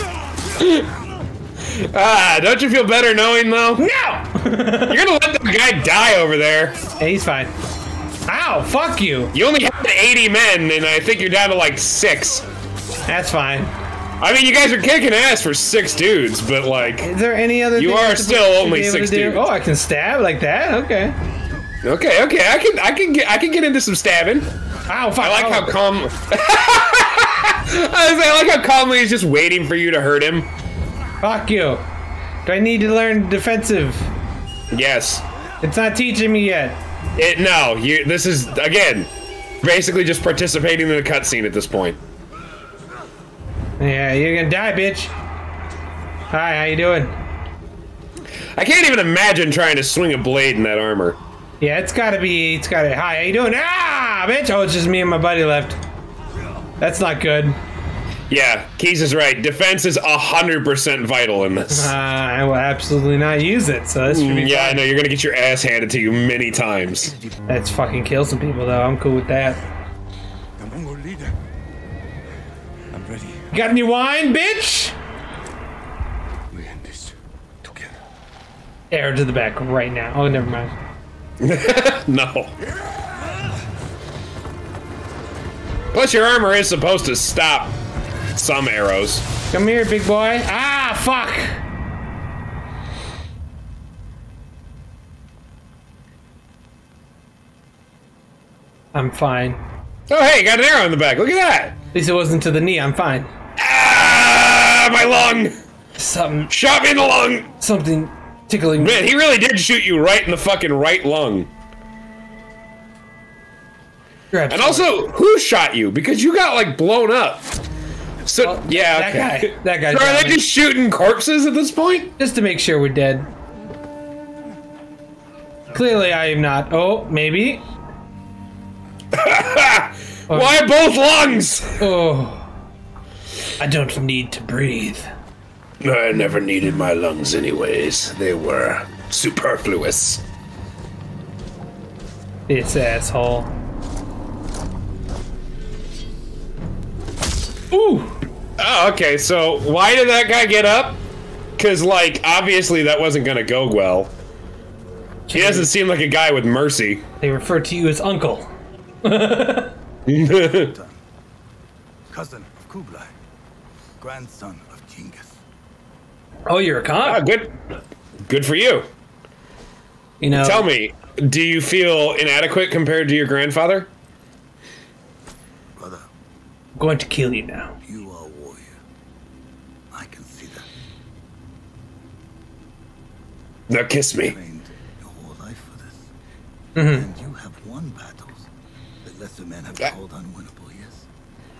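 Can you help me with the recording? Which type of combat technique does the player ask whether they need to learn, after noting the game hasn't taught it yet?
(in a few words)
Defensive.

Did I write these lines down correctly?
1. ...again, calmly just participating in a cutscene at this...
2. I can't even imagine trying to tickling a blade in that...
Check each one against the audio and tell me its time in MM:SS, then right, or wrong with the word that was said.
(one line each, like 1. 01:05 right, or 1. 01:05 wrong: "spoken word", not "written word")
1. 00:38 wrong: "basically", not "calmly"
2. 00:48 wrong: "swing", not "tickling".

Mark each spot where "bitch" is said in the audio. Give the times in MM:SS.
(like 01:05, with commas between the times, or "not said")
00:44, 00:54, 01:14.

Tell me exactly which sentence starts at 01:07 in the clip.
That's fucking kill some people, though.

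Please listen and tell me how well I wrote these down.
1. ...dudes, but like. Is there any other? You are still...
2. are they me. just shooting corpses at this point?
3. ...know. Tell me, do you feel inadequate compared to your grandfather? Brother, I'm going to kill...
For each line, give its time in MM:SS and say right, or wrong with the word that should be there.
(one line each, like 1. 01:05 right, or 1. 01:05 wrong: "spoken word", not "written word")
1. 00:15 right
2. 01:59 right
3. 02:50 right.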